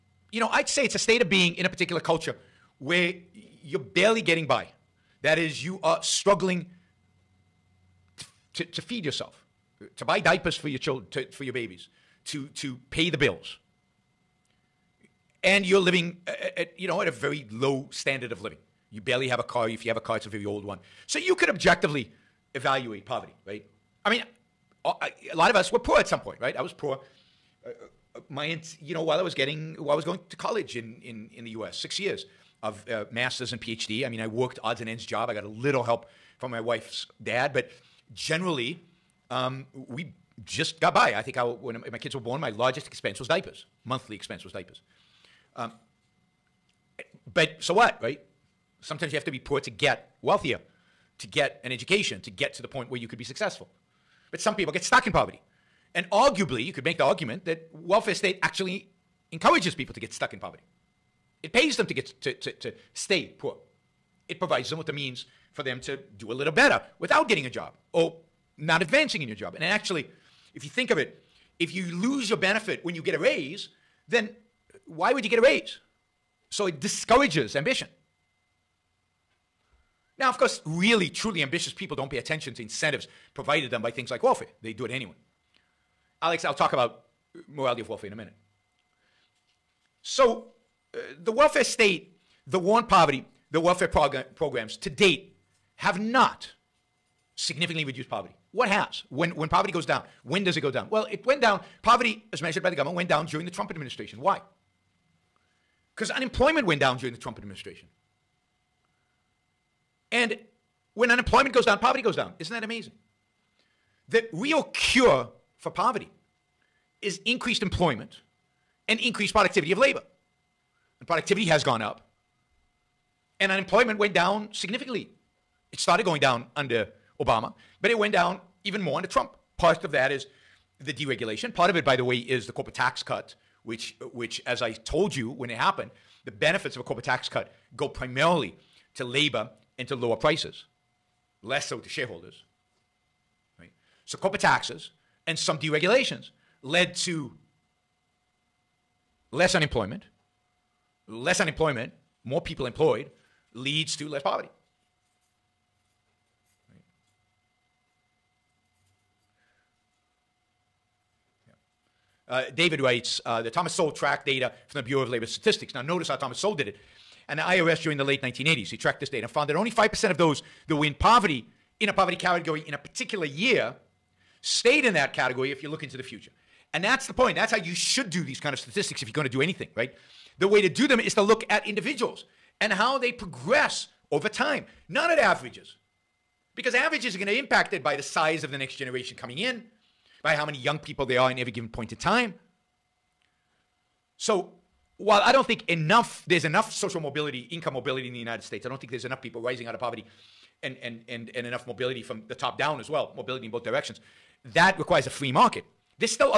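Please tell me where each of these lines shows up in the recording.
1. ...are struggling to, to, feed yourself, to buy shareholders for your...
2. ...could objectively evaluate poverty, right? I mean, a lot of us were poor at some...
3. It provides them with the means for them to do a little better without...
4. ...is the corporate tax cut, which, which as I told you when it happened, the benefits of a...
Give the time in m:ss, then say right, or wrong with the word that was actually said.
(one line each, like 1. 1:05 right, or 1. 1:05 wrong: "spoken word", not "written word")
1. 0:05 wrong: "diapers", not "shareholders"
2. 0:21 right
3. 1:04 right
4. 2:12 right.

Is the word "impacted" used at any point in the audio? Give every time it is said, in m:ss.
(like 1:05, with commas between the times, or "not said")
3:07.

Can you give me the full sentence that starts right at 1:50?
And when unemployment goes down, poverty goes down.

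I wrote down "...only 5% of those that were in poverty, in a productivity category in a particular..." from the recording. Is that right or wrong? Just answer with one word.
wrong.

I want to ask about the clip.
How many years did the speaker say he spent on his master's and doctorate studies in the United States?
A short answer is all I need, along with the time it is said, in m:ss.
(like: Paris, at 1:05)
6, at 0:31.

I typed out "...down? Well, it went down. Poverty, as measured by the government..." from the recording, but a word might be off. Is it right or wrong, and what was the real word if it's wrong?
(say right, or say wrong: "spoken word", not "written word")
right.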